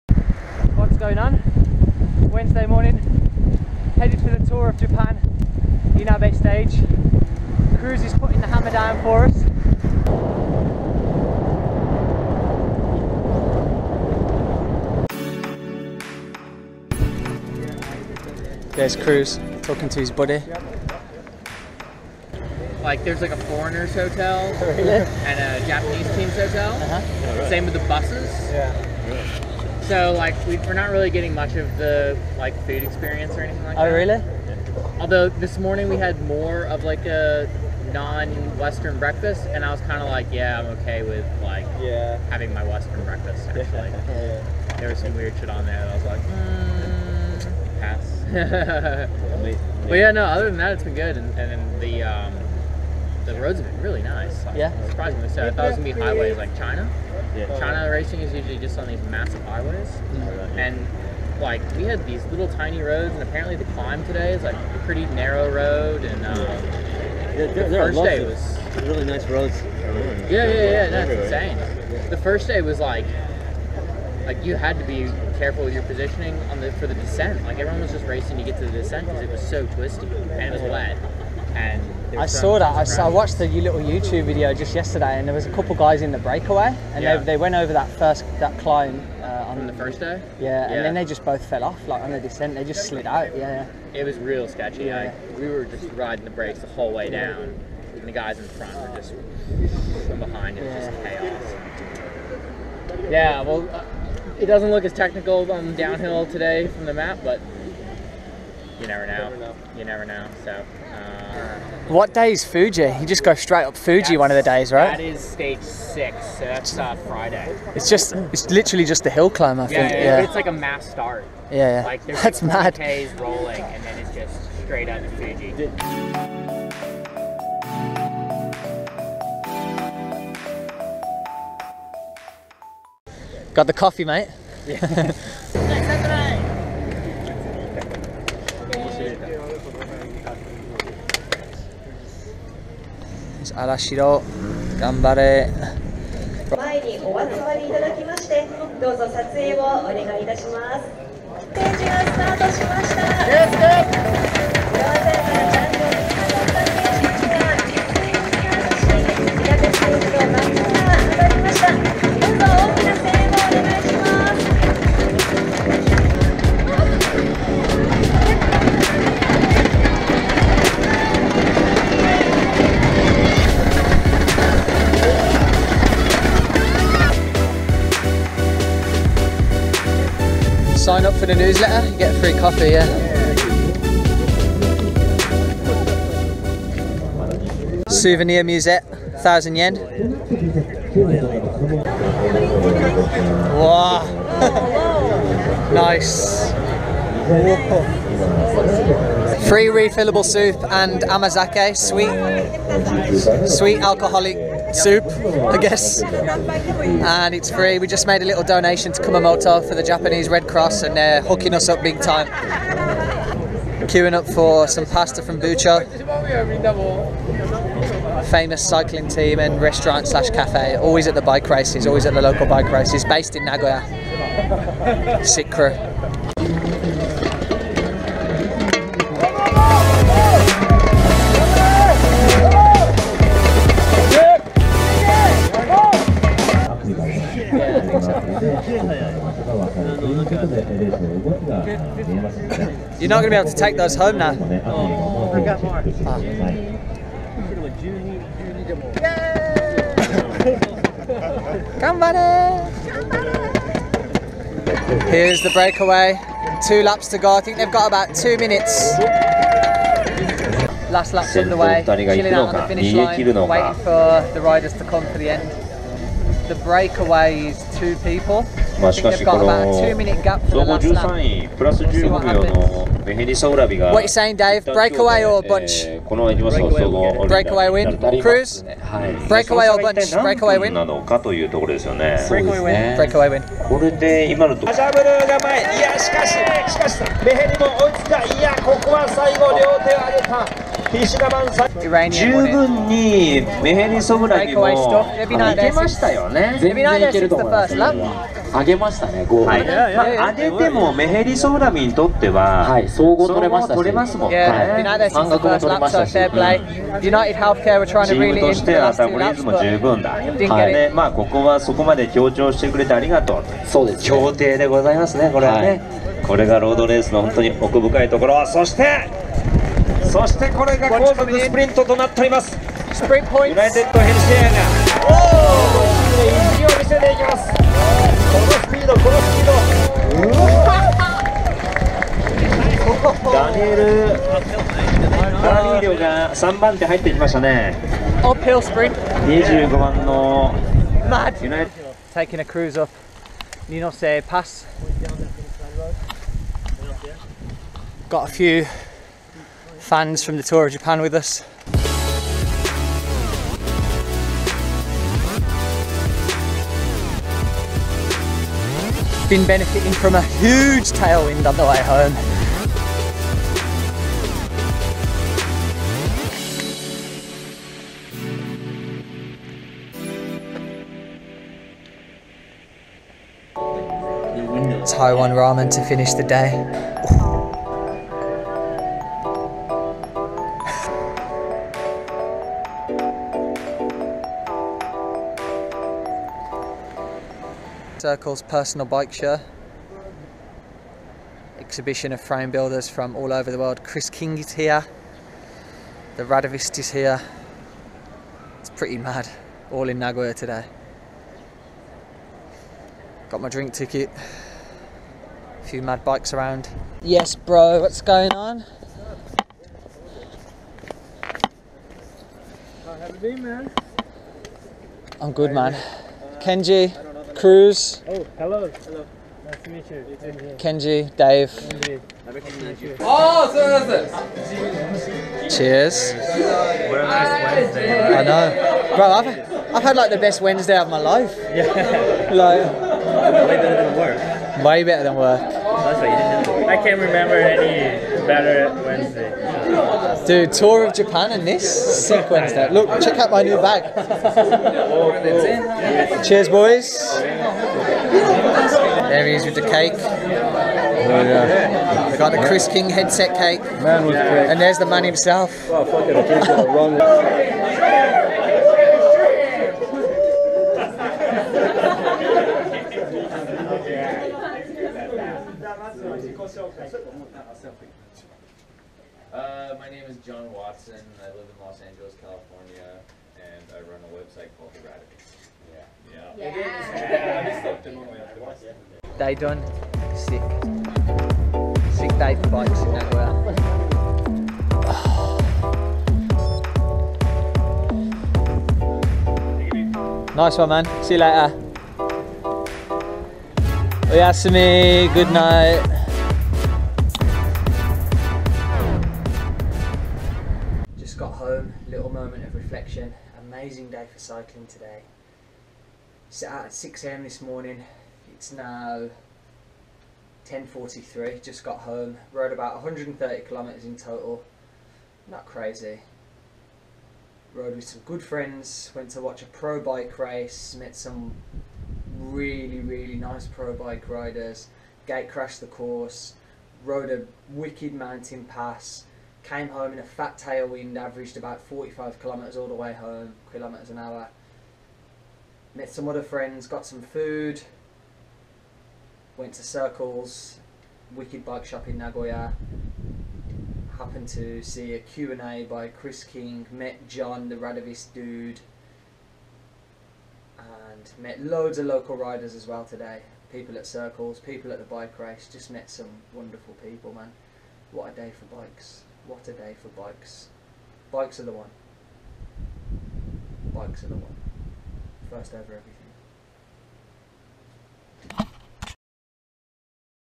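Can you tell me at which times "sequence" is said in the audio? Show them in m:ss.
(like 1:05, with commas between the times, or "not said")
7:22.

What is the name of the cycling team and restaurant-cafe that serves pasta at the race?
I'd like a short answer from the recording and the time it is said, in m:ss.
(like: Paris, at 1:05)
Bucho, at 3:35.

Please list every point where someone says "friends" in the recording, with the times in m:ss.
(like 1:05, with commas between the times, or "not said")
8:38, 8:56.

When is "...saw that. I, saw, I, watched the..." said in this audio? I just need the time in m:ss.
1:22.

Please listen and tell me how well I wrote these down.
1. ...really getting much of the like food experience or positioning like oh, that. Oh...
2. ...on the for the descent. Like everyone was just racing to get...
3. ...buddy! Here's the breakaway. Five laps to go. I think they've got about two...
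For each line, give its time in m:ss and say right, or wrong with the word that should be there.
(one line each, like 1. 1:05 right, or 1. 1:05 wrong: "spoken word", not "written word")
1. 0:30 wrong: "anything", not "positioning"
2. 1:16 right
3. 4:11 wrong: "Two", not "Five".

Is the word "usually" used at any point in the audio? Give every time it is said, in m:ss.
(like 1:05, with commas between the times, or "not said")
0:58.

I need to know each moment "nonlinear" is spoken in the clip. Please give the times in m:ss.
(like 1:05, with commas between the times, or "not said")
not said.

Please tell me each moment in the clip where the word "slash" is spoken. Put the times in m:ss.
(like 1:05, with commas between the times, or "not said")
3:40.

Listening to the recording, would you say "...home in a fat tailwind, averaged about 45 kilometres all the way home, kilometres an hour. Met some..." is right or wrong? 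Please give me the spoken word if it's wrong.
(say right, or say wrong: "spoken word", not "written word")
right.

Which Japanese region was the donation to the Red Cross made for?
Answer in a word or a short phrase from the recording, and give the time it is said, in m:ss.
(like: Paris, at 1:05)
Kumamoto, at 3:29.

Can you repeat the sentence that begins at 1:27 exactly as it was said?
they, they went over that first that climb uh, on From the first day.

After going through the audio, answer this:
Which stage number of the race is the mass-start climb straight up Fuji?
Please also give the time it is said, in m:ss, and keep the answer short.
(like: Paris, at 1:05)
6, at 1:55.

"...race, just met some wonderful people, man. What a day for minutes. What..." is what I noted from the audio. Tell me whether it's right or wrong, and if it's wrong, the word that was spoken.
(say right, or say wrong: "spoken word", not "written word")
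wrong: "bikes", not "minutes".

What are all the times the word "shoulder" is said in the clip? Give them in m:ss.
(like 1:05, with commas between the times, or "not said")
not said.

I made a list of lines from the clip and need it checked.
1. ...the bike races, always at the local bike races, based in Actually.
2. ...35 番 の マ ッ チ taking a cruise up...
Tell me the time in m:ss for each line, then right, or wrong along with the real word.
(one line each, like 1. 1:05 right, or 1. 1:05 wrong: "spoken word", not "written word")
1. 3:41 wrong: "Nagoya", not "Actually"
2. 5:38 wrong: "25", not "35".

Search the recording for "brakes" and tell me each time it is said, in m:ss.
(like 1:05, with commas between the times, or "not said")
1:36.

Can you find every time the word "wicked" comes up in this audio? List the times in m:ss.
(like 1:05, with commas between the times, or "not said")
8:47, 9:01.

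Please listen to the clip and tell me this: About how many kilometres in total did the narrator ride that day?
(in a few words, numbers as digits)
130.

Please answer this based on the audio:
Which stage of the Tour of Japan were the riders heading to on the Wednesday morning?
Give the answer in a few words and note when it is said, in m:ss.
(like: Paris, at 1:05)
Inabe, at 0:05.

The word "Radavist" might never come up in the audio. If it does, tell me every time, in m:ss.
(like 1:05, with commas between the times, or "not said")
6:36, 7:54, 9:07.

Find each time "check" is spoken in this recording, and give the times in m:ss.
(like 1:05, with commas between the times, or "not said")
7:23.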